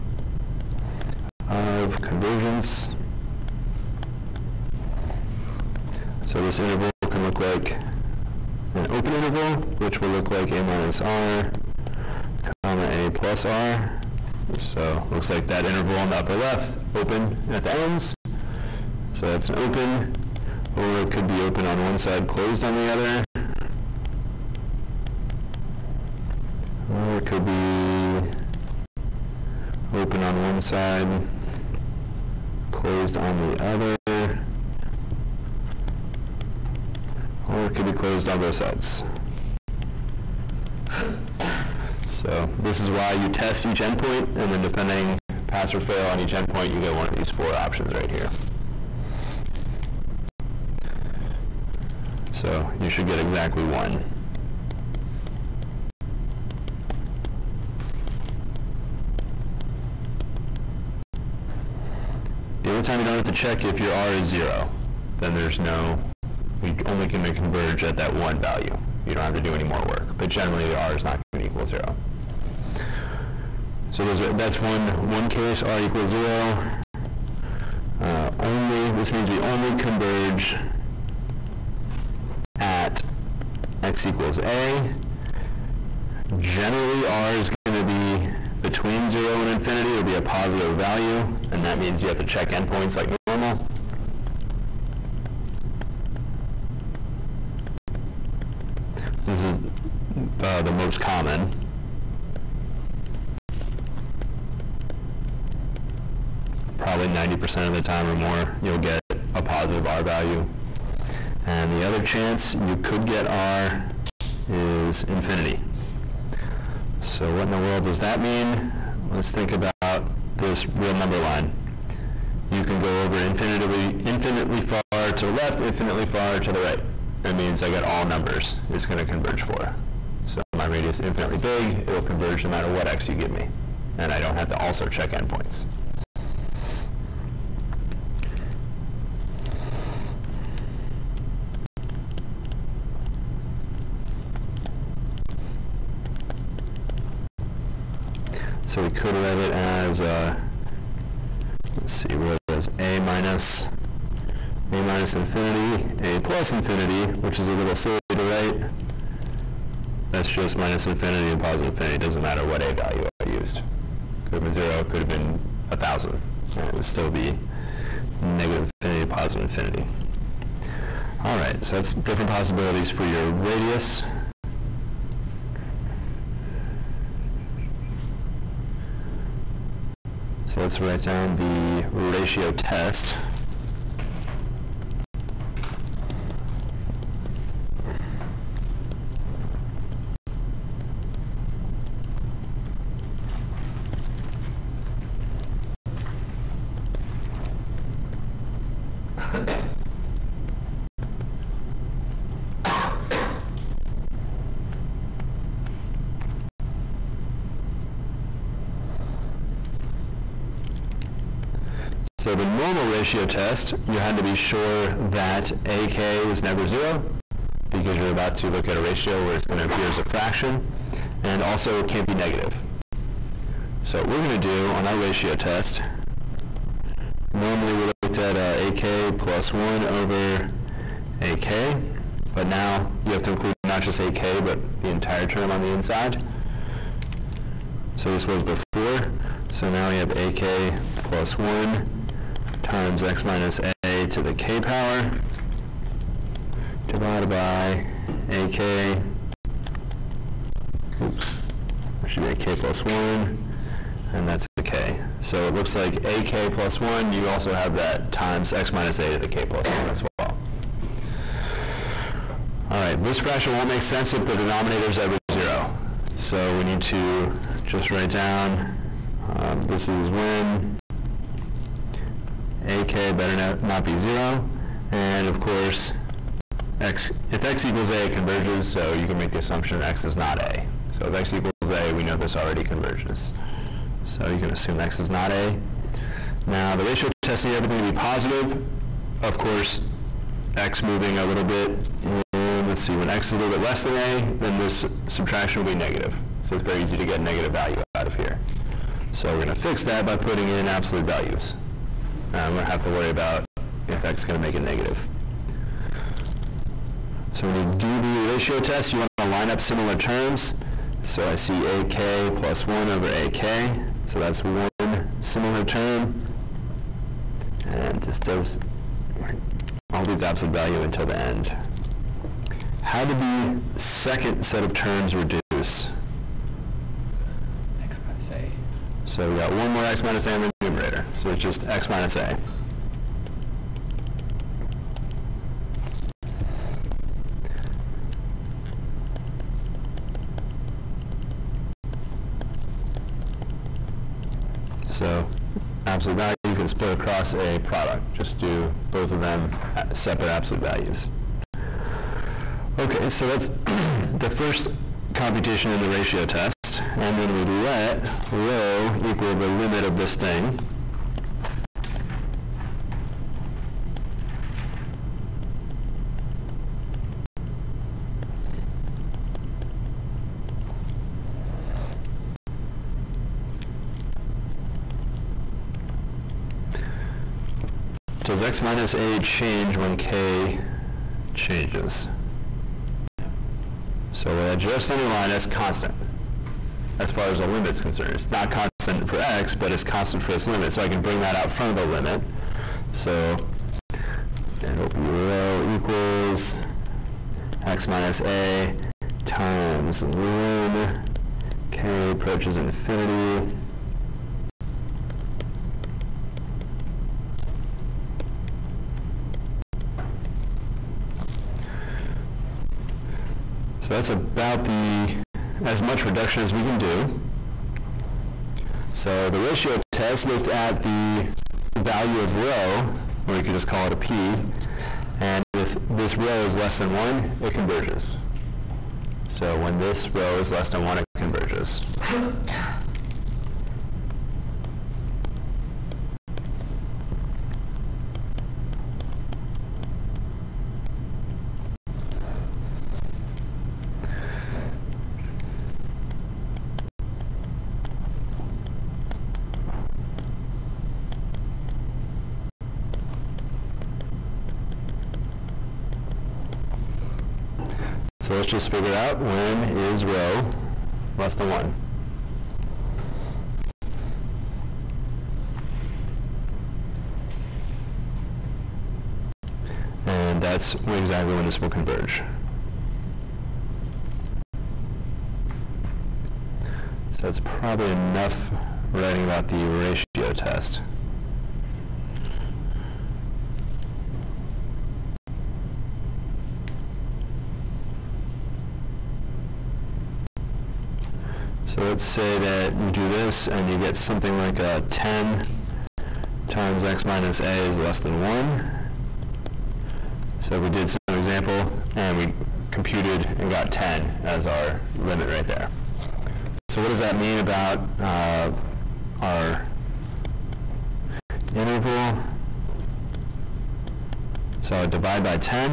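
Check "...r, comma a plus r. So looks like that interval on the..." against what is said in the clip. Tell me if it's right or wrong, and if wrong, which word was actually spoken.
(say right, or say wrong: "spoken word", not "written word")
right.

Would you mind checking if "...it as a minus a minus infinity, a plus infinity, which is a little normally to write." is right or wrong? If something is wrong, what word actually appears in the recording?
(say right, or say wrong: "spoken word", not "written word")
wrong: "silly", not "normally".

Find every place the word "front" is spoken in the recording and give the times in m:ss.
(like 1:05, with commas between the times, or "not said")
6:31.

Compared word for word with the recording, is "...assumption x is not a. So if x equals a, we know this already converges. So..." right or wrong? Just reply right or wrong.
right.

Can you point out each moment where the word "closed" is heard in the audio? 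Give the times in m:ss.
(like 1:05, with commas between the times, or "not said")
0:22, 0:32, 0:37.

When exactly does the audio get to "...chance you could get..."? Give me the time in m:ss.
1:52.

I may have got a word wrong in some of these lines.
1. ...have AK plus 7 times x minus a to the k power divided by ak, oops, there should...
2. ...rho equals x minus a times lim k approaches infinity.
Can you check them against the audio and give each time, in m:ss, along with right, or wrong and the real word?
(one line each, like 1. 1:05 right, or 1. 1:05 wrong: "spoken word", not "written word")
1. 3:59 wrong: "1", not "7"
2. 6:35 right.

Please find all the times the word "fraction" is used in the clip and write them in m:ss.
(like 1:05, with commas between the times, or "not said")
3:40, 4:23.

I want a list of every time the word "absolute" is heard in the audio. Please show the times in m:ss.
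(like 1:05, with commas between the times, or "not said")
5:00, 5:20, 5:45, 5:50.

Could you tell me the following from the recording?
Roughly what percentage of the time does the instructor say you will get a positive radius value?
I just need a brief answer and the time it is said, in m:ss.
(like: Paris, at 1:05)
90%, at 1:47.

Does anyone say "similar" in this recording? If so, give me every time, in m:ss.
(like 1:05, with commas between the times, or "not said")
5:09, 5:15.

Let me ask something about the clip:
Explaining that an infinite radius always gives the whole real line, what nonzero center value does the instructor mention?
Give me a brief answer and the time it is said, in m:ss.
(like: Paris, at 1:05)
1000, at 2:45.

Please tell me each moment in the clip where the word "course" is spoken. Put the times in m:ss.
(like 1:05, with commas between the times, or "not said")
4:35, 4:49.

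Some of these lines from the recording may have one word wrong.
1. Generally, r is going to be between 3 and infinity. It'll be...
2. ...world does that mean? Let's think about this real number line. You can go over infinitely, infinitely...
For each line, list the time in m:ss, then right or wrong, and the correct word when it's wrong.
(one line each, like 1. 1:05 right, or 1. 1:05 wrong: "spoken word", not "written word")
1. 1:26 wrong: "0", not "3"
2. 1:57 right.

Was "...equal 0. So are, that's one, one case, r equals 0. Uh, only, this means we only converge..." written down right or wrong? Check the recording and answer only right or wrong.
right.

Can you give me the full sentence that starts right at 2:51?
All right, so that's different possibilities for your radius.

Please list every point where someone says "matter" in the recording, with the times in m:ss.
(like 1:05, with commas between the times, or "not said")
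2:12, 2:42.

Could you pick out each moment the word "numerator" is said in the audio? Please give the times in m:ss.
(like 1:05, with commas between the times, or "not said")
5:30.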